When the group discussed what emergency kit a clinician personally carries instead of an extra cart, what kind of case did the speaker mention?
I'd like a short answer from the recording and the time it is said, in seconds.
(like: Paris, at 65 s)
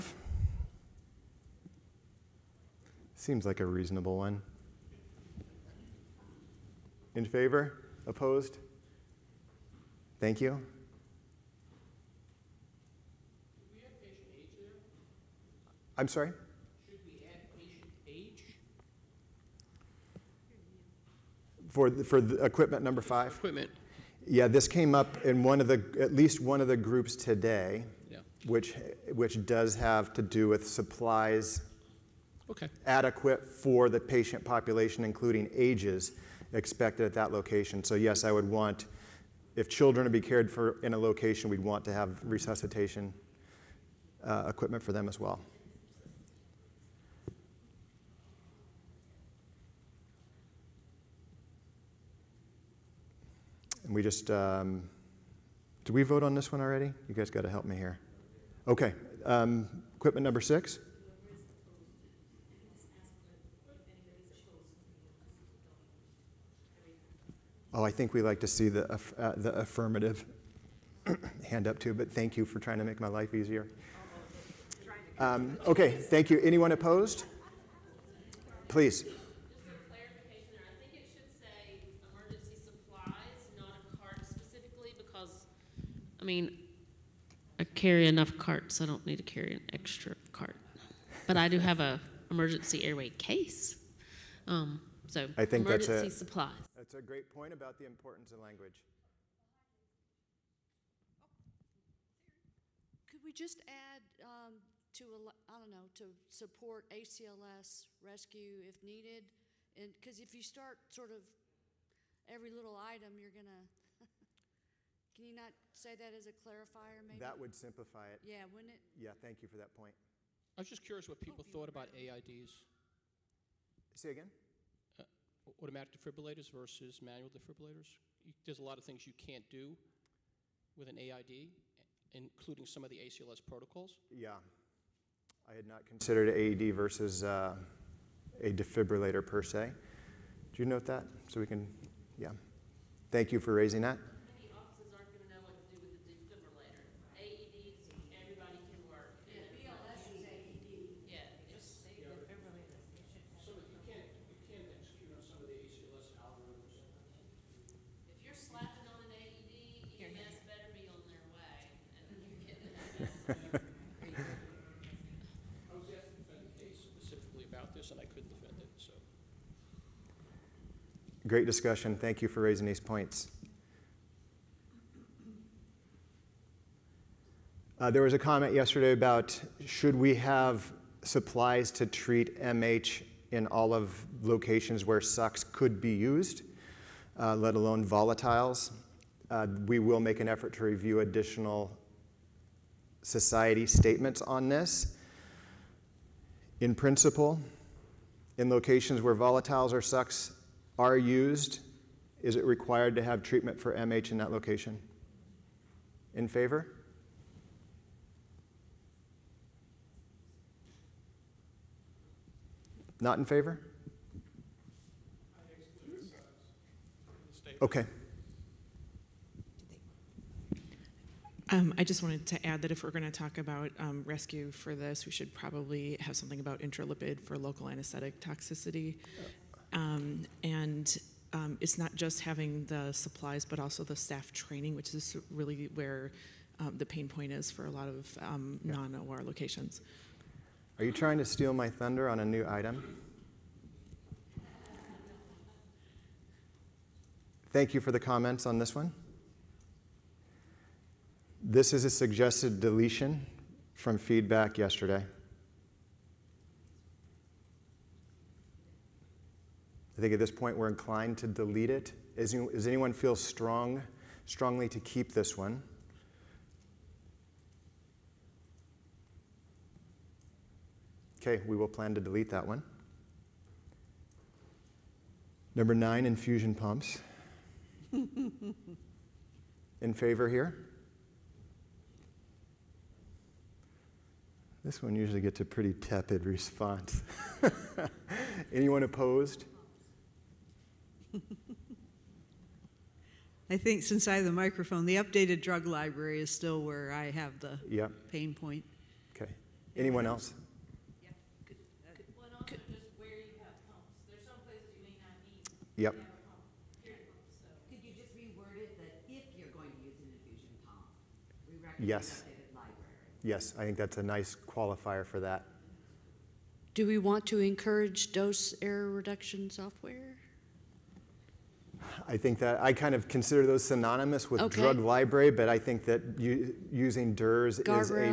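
emergency airway case, at 92 s.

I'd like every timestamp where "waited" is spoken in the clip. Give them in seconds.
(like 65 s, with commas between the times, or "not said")
not said.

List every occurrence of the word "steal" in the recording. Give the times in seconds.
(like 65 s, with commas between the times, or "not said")
241 s.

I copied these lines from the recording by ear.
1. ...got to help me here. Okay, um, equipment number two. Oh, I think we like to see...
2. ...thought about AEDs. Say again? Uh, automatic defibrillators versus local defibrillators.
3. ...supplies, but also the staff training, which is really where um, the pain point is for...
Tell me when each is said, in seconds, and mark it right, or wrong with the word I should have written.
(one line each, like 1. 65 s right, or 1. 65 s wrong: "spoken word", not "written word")
1. 57 s wrong: "six", not "two"
2. 121 s wrong: "manual", not "local"
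3. 232 s right.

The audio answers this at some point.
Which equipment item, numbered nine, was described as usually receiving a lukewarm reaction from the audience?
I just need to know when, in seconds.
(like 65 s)
276 s.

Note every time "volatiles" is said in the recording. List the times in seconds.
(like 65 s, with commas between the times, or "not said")
187 s, 199 s.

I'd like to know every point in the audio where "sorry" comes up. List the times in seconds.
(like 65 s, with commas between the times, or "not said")
16 s.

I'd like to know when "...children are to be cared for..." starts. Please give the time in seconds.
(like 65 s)
39 s.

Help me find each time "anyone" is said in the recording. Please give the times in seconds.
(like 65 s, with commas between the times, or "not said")
76 s, 262 s, 288 s.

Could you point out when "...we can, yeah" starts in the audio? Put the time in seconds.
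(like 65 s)
141 s.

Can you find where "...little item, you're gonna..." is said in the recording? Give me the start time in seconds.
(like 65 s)
112 s.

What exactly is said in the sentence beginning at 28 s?
which, which does have to do with supplies okay.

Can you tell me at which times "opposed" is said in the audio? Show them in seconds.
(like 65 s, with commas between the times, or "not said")
8 s, 76 s, 288 s.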